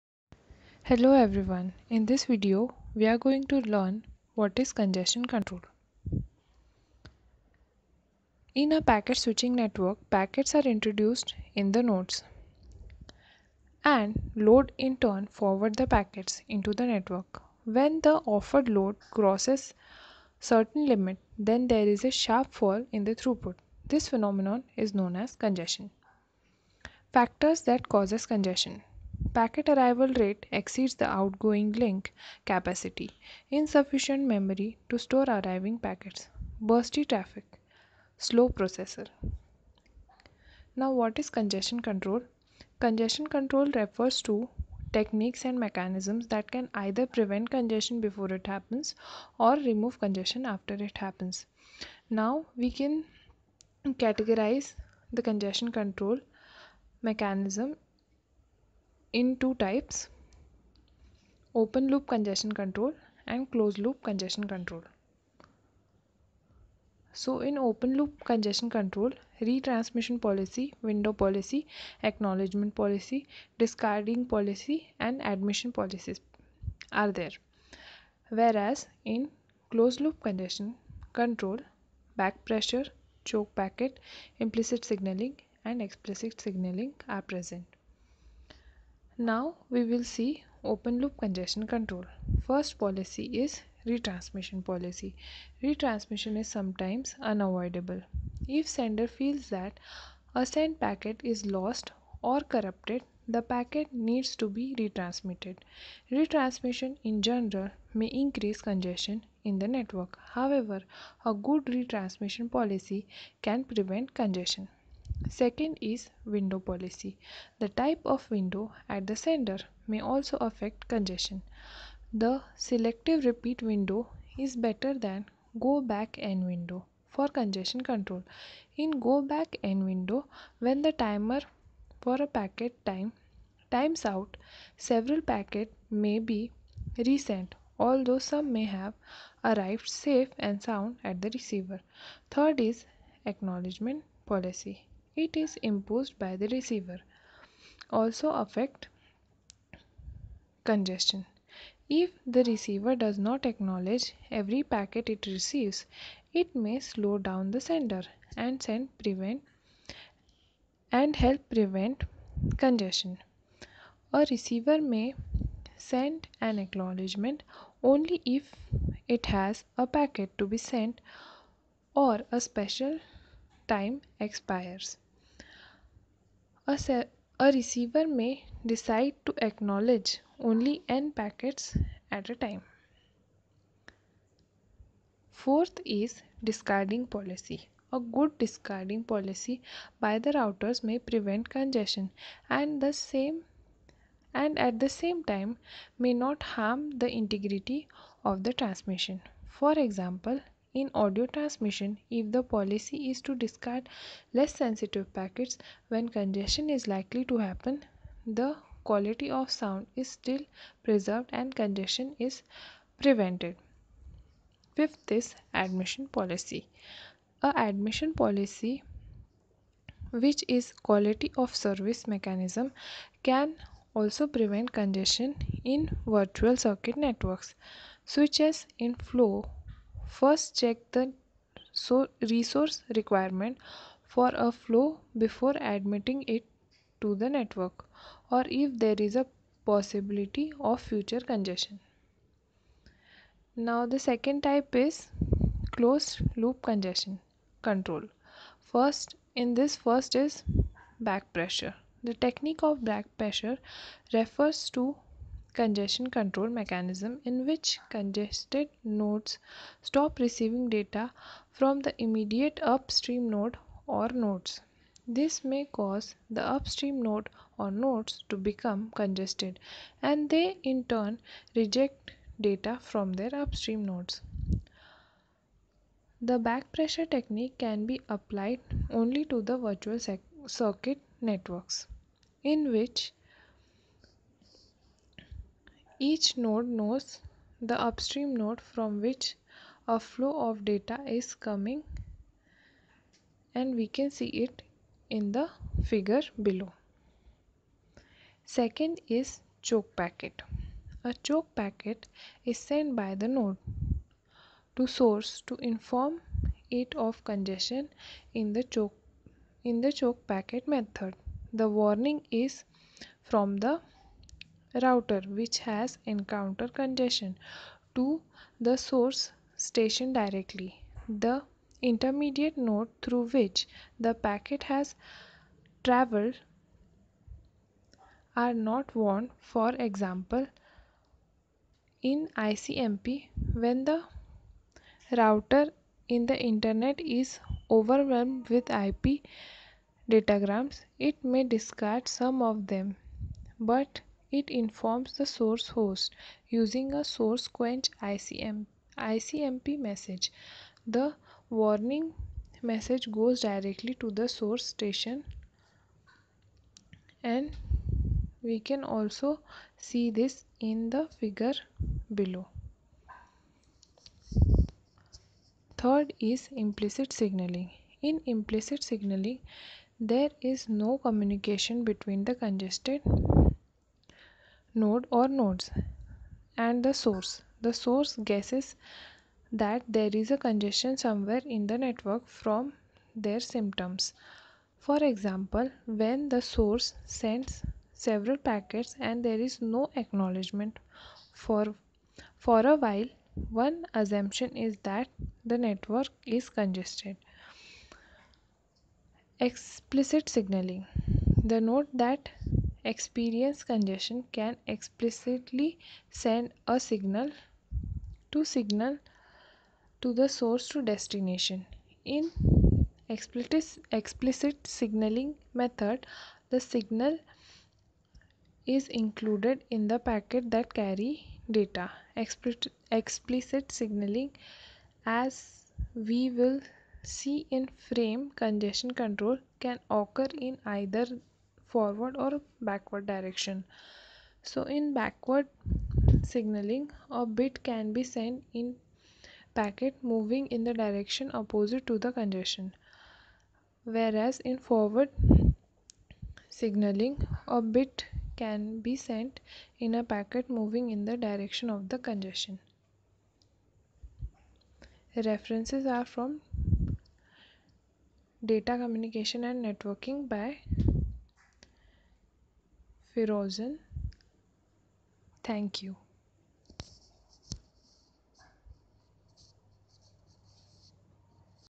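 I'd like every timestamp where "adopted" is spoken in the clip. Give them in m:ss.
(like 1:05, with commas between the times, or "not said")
not said.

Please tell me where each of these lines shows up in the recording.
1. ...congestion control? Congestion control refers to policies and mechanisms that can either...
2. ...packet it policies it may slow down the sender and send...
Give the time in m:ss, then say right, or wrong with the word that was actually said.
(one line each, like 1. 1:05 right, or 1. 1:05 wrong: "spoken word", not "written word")
1. 0:41 wrong: "techniques", not "policies"
2. 2:34 wrong: "receives", not "policies".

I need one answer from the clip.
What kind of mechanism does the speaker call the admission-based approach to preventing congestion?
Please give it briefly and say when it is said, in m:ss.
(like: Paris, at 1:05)
Quality of service, at 3:40.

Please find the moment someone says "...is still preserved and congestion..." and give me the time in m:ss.
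3:29.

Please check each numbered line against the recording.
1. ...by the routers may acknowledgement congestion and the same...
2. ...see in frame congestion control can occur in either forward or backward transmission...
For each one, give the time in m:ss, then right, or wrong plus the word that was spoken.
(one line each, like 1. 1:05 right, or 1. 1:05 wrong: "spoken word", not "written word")
1. 3:09 wrong: "prevent", not "acknowledgement"
2. 7:07 wrong: "direction", not "transmission".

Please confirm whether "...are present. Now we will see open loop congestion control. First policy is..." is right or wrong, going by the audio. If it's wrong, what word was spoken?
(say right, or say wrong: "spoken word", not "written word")
right.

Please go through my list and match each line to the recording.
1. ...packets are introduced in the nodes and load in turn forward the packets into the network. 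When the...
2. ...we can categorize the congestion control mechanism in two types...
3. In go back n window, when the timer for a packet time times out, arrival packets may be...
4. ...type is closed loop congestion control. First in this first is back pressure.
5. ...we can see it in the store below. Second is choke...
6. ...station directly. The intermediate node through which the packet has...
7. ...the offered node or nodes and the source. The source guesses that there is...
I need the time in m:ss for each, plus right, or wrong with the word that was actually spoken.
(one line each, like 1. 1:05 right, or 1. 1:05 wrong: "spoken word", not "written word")
1. 0:10 right
2. 0:52 right
3. 2:08 wrong: "several", not "arrival"
4. 4:04 right
5. 4:53 wrong: "figure", not "store"
6. 5:19 right
7. 6:12 wrong: "congested", not "offered".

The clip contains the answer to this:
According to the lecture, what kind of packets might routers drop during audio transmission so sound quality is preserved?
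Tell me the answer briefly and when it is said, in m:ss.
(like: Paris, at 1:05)
Less sensitive packets, at 3:24.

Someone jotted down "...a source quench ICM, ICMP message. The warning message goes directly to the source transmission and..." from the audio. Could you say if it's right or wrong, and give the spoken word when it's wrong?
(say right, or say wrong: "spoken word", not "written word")
wrong: "station", not "transmission".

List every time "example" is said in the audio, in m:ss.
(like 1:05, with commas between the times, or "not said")
3:19, 5:29, 6:25.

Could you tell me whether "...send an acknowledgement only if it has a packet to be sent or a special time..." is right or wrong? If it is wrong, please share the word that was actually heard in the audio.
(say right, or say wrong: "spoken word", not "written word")
right.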